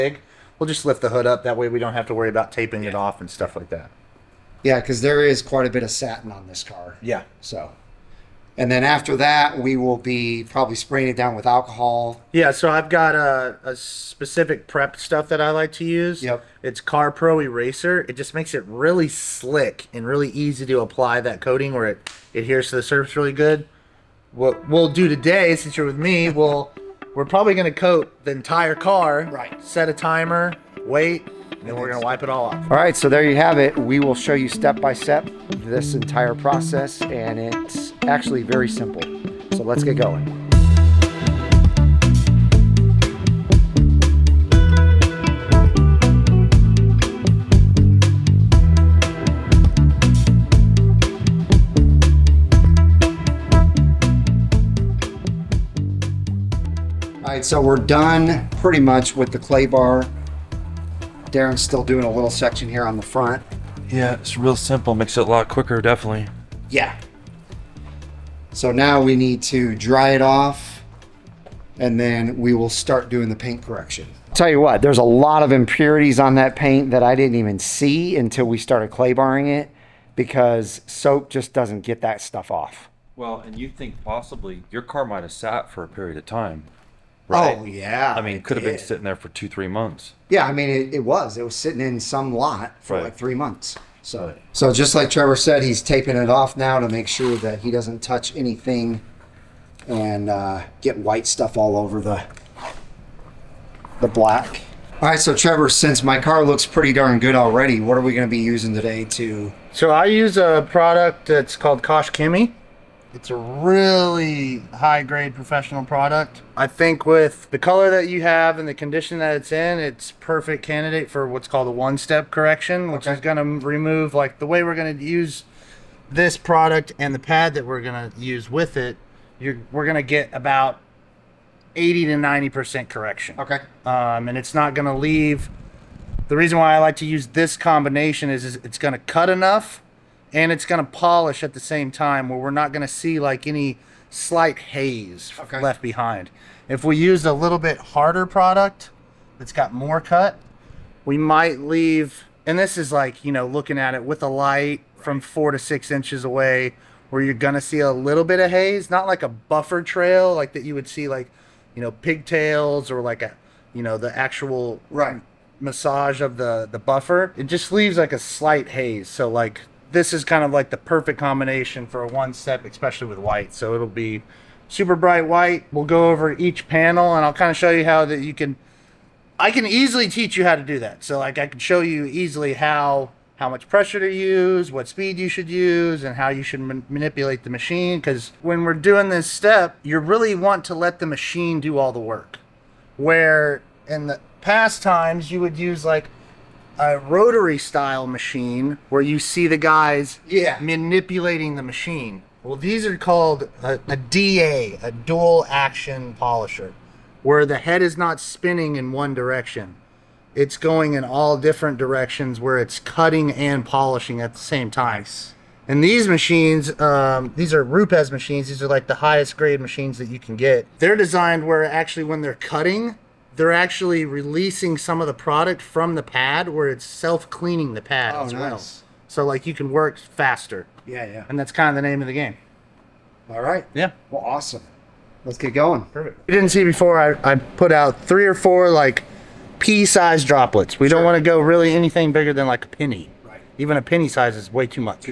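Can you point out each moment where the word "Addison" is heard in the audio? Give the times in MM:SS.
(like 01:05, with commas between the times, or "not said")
not said.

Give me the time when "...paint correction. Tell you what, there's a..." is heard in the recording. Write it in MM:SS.
01:13.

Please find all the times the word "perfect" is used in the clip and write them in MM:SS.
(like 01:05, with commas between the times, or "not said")
02:00, 02:50, 03:55.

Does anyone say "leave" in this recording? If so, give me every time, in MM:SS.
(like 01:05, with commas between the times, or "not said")
02:14, 02:31, 02:47.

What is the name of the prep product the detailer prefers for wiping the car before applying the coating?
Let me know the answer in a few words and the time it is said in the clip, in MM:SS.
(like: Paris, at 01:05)
CarPro Eraser, at 00:16.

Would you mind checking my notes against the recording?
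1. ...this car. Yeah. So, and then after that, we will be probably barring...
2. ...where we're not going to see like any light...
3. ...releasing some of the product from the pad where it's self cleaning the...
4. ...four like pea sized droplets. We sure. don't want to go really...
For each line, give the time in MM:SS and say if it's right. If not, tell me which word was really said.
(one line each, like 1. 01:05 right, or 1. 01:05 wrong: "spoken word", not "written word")
1. 00:06 wrong: "spraying", not "barring"
2. 02:22 wrong: "slight", not "light"
3. 03:44 right
4. 03:58 right.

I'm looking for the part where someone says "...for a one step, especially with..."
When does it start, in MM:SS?
02:51.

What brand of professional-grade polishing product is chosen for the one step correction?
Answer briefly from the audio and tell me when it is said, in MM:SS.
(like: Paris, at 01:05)
Koch-Chemie, at 01:51.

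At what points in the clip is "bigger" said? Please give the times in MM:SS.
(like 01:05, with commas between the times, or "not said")
04:02.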